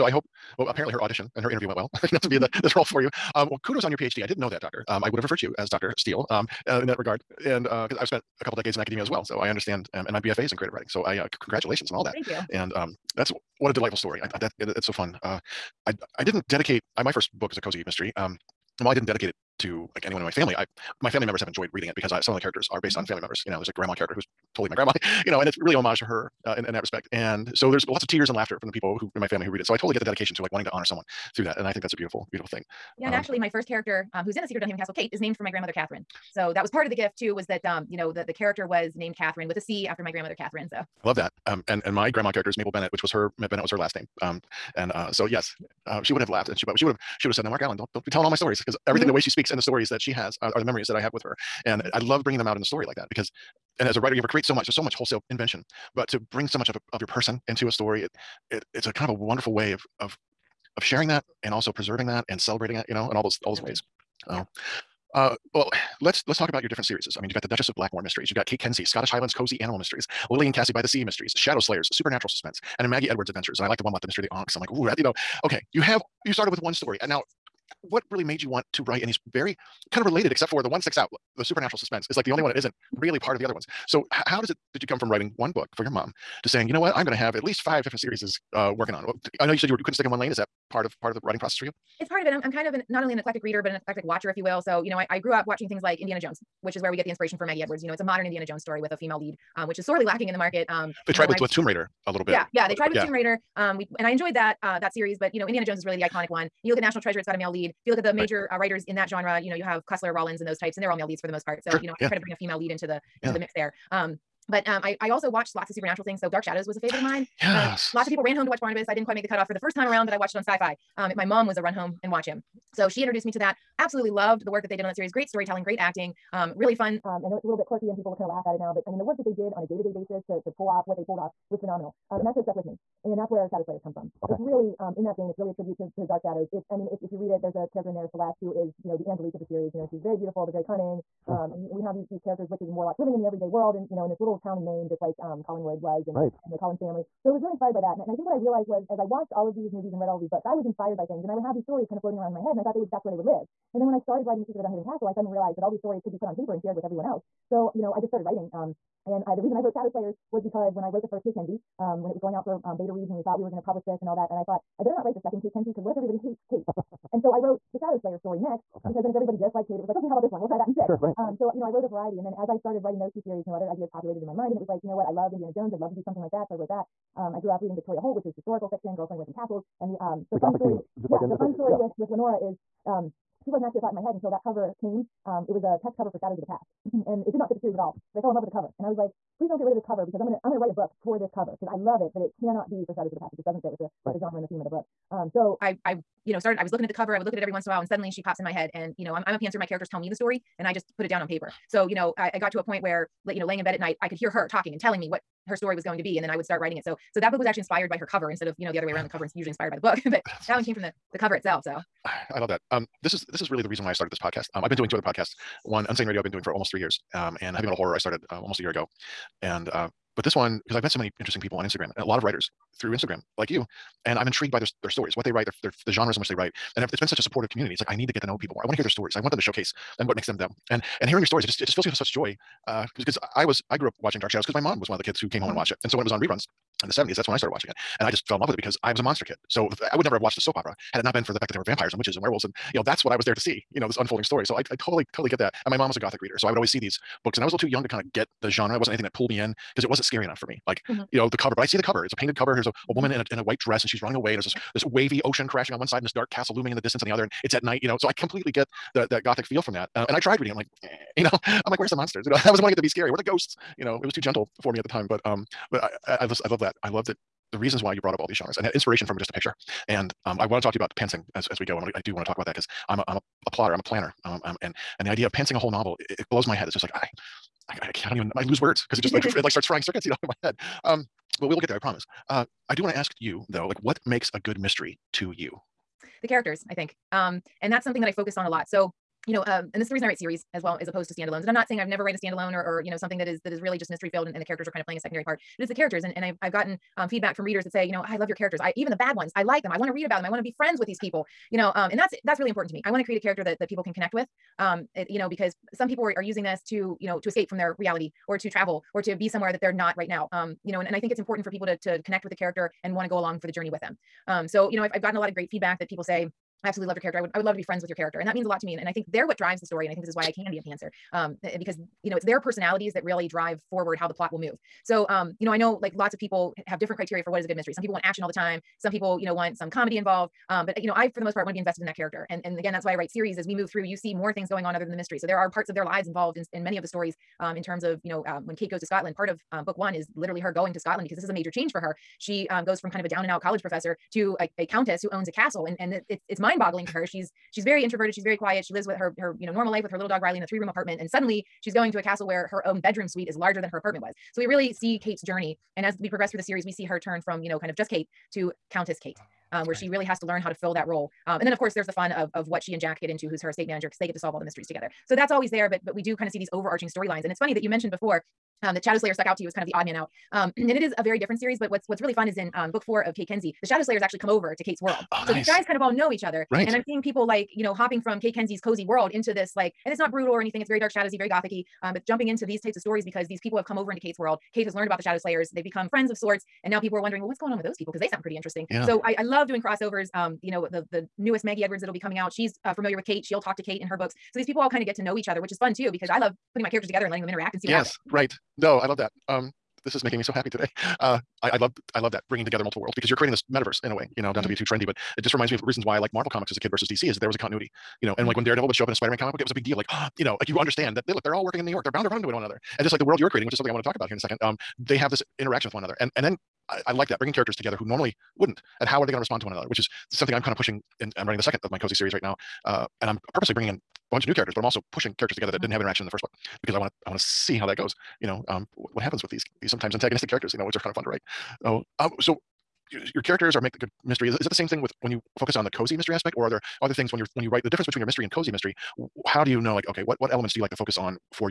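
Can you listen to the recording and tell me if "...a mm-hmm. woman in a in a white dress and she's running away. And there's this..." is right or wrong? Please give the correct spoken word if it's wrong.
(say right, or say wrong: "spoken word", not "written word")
right.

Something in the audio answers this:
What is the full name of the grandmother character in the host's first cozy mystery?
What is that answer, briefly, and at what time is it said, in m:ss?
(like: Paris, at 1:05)
Mabel Bennett, at 0:42.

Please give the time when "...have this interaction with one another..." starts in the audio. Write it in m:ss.
6:54.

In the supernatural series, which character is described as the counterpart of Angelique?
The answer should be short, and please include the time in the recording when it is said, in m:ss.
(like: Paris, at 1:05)
Celeste, at 2:18.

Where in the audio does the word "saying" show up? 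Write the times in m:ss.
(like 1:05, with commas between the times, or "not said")
1:26, 4:51.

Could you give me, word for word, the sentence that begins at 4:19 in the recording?
Uh, and I tried reading it.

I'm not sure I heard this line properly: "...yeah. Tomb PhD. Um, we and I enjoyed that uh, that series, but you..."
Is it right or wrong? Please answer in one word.
wrong.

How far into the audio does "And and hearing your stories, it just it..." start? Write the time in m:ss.
3:50.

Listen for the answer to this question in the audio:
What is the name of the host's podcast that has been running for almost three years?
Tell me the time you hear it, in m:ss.
3:35.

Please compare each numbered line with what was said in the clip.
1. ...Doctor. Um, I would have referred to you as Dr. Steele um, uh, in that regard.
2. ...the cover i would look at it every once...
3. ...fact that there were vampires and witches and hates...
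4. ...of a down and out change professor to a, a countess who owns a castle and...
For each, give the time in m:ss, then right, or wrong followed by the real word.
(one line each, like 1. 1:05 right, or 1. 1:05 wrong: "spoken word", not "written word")
1. 0:04 right
2. 3:16 right
3. 4:01 wrong: "werewolves", not "hates"
4. 5:42 wrong: "college", not "change".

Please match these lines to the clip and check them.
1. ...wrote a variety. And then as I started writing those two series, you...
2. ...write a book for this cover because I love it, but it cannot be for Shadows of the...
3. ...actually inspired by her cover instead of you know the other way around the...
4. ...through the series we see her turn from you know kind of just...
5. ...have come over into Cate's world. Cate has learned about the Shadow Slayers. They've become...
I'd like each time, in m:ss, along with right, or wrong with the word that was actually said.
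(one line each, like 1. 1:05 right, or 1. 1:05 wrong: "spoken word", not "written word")
1. 2:51 right
2. 3:10 right
3. 3:27 right
4. 5:56 right
5. 6:23 right.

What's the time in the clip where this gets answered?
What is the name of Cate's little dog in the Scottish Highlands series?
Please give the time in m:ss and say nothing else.
5:50.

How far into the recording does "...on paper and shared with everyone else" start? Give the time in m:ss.
2:36.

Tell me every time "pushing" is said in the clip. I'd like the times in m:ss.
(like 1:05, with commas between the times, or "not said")
7:00, 7:04.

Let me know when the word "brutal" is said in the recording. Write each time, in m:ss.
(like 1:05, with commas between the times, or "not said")
6:20.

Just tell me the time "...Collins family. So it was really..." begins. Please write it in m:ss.
2:26.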